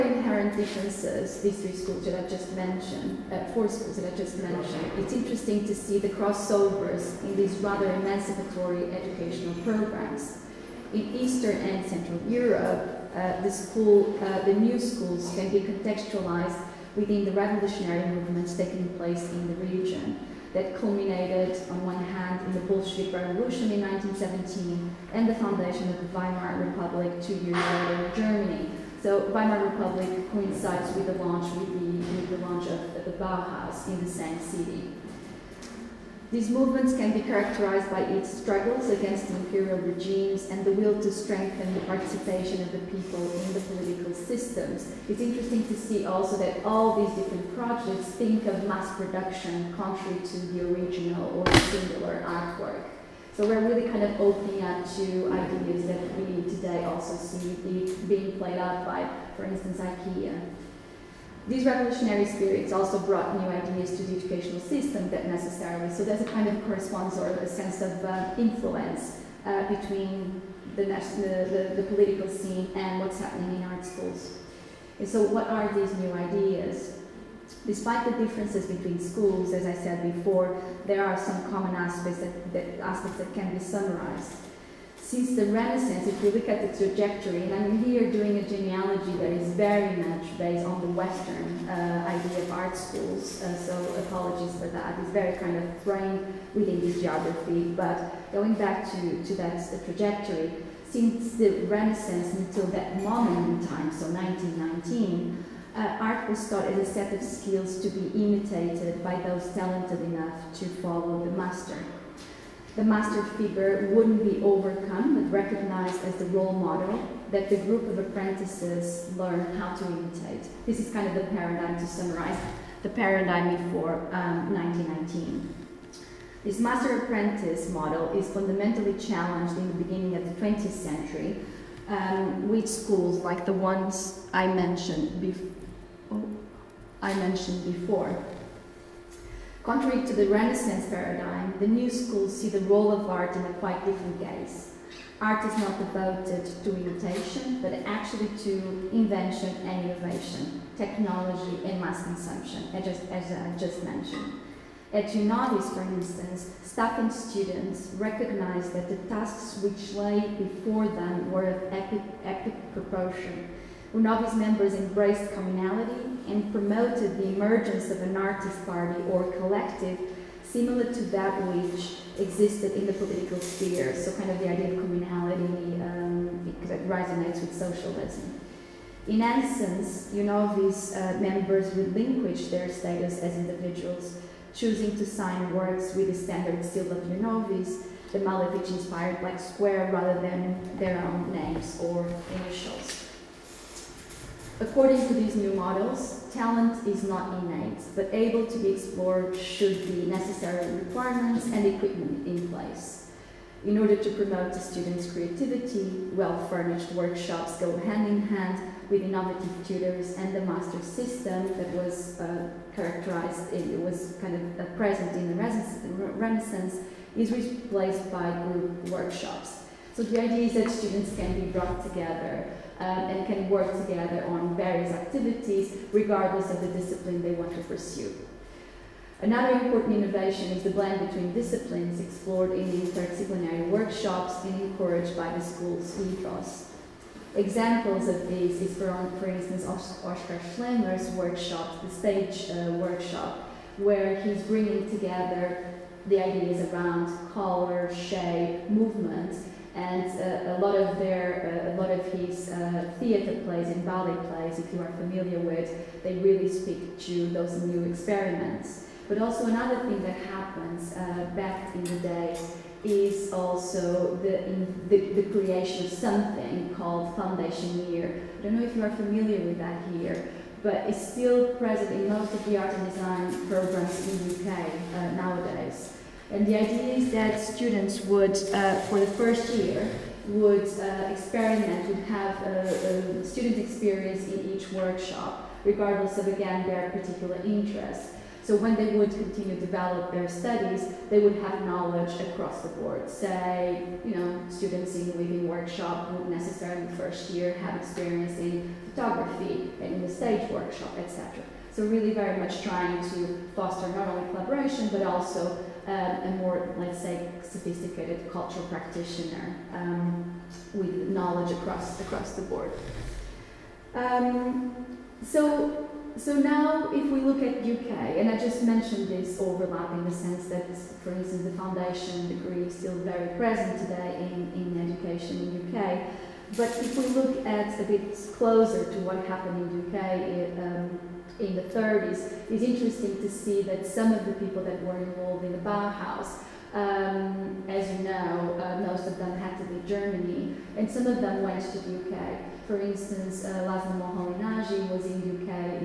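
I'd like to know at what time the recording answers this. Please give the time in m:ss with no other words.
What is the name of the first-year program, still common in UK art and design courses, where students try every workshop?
4:27.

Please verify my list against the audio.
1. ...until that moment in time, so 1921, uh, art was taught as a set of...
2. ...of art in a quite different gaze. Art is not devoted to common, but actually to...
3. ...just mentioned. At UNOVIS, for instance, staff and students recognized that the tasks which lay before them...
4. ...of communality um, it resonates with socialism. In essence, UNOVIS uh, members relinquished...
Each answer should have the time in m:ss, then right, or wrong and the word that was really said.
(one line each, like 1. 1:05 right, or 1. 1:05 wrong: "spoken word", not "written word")
1. 1:42 wrong: "1919", not "1921"
2. 2:22 wrong: "imitation", not "common"
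3. 2:33 right
4. 2:54 right.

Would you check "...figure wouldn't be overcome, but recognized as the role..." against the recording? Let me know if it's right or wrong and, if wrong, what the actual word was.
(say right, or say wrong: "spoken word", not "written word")
right.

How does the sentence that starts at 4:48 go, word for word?
So when they would continue to develop their studies, they would have knowledge across the board.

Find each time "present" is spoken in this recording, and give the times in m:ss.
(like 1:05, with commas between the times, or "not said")
3:34, 4:31, 5:23.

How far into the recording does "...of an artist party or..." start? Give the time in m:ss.
2:47.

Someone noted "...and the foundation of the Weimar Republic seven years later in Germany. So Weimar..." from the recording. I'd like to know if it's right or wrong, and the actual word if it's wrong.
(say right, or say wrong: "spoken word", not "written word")
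wrong: "two", not "seven".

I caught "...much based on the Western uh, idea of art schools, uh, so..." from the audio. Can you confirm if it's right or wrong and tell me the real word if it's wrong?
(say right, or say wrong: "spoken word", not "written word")
right.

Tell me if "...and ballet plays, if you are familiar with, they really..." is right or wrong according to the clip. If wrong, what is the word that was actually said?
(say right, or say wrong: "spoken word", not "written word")
right.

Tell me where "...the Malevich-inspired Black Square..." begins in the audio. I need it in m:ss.
3:08.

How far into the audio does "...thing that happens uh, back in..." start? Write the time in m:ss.
4:19.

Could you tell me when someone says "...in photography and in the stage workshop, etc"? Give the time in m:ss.
4:58.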